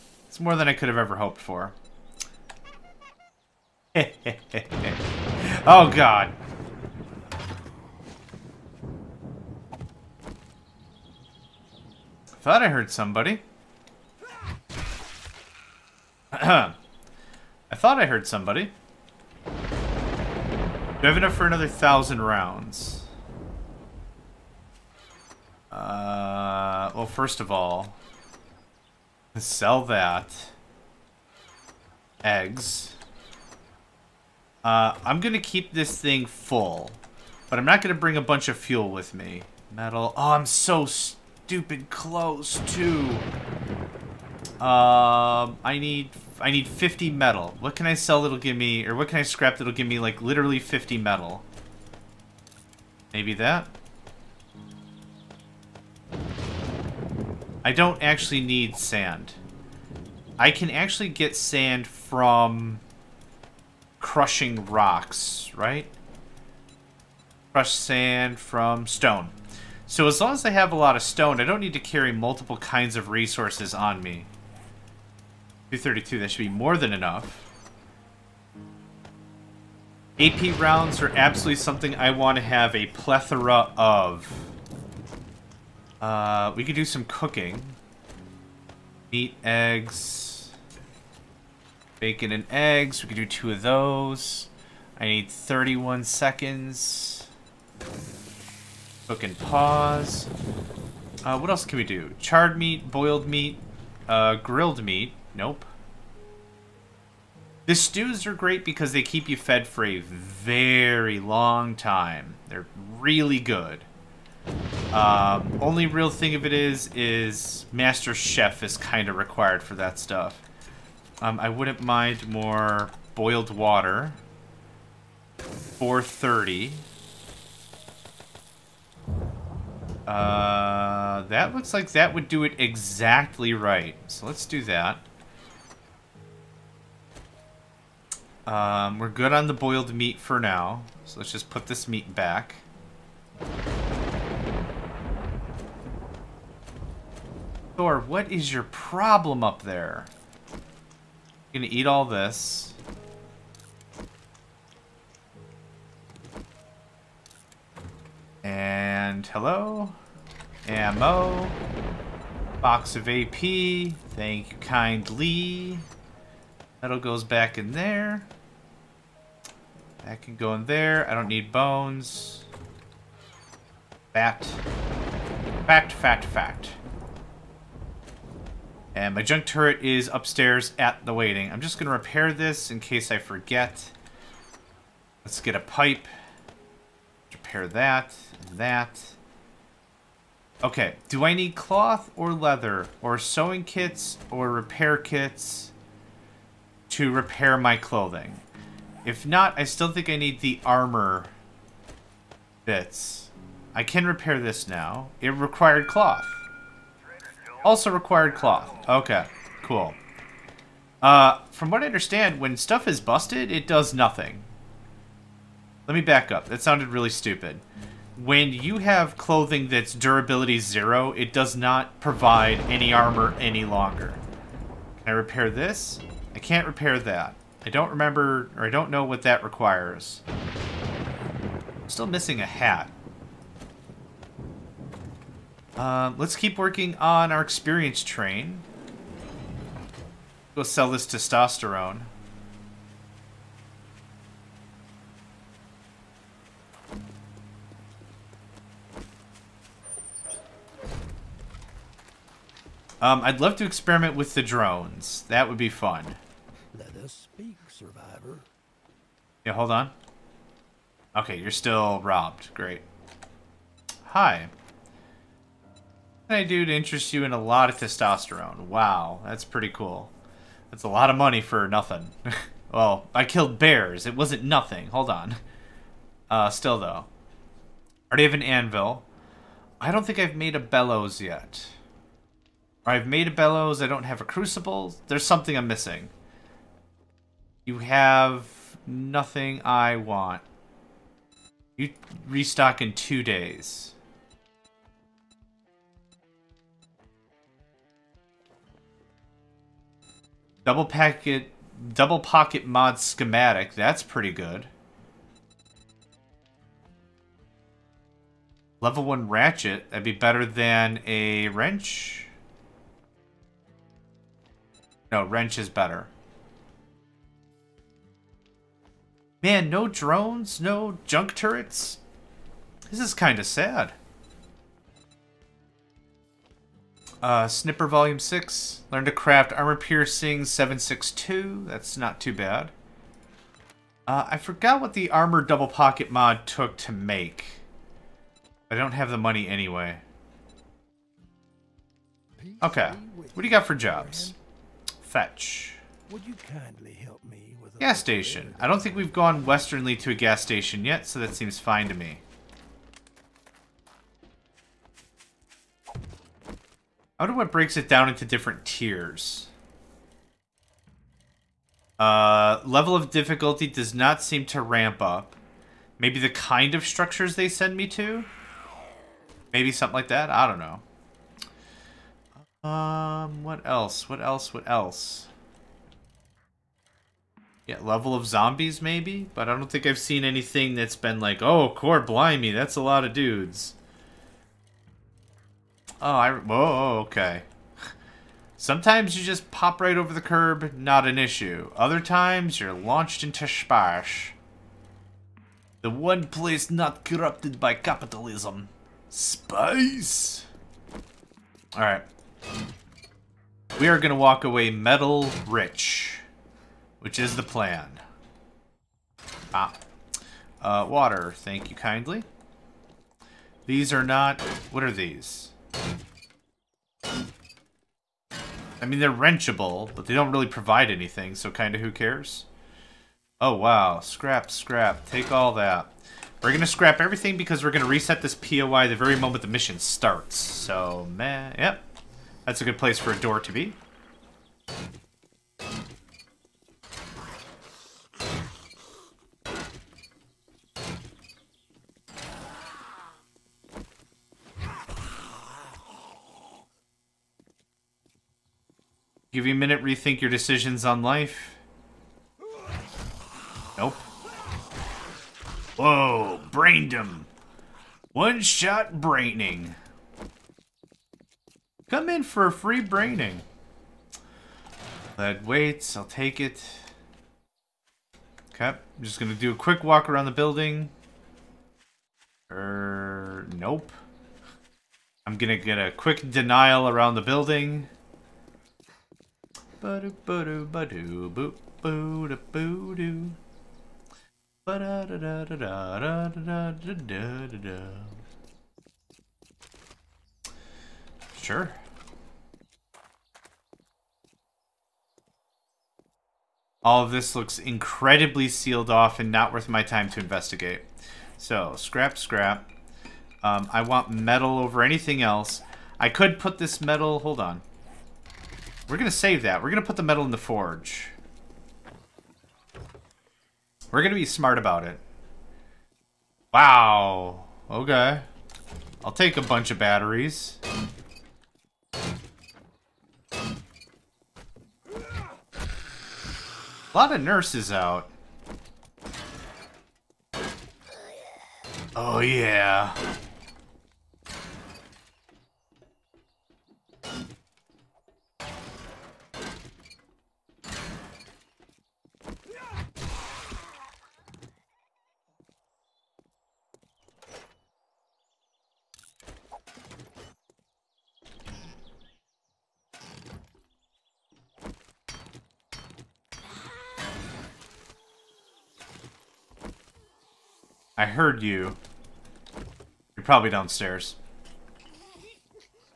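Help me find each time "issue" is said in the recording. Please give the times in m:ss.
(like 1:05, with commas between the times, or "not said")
6:31.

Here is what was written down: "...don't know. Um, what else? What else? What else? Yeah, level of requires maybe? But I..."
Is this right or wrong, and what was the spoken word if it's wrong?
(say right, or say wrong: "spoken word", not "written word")
wrong: "zombies", not "requires".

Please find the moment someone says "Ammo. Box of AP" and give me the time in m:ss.
2:40.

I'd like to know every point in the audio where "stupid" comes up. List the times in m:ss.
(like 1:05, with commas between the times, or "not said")
0:40, 3:37.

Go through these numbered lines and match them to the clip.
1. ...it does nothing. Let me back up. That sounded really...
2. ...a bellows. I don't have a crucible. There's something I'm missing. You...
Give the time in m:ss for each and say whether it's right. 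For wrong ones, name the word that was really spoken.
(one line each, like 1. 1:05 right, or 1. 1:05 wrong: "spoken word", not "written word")
1. 3:33 right
2. 4:43 right.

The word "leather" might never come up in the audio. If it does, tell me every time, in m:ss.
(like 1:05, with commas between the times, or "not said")
3:12.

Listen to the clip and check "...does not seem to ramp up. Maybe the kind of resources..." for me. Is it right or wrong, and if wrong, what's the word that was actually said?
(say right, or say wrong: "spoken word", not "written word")
wrong: "structures", not "resources".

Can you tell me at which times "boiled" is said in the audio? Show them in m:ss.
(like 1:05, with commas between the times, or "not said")
1:42, 2:03, 2:19.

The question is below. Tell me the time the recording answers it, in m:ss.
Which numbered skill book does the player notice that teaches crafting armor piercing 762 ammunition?
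5:27.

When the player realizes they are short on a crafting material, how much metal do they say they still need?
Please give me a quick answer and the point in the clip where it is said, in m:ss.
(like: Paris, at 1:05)
50, at 0:46.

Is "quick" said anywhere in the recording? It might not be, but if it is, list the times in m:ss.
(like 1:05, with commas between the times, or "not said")
7:49, 7:55.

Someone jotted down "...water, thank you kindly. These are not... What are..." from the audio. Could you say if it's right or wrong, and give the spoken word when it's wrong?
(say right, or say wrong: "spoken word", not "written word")
right.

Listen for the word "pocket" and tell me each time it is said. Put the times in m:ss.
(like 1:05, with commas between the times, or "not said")
5:02, 5:35.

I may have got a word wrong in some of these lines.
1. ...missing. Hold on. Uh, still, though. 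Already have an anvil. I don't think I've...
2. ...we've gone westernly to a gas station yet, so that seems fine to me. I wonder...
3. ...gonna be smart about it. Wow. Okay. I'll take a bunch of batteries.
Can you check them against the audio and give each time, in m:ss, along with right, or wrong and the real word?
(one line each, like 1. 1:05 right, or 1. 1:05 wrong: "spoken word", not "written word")
1. 4:34 wrong: "nothing", not "missing"
2. 5:48 right
3. 8:34 right.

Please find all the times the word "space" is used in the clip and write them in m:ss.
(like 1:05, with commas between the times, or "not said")
6:33, 6:39.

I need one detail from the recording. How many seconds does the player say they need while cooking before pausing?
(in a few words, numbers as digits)
31.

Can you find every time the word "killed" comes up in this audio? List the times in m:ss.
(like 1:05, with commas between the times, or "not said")
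4:33.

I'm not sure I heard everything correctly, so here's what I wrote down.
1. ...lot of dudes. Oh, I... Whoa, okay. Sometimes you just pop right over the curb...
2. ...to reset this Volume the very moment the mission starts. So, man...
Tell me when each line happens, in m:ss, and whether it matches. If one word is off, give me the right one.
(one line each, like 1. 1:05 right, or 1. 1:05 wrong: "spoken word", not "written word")
1. 6:22 right
2. 7:07 wrong: "POI", not "Volume".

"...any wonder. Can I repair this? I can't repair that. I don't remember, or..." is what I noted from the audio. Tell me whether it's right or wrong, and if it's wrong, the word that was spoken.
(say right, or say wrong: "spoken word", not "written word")
wrong: "longer", not "wonder".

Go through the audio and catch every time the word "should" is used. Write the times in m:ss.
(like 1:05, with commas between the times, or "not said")
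1:16.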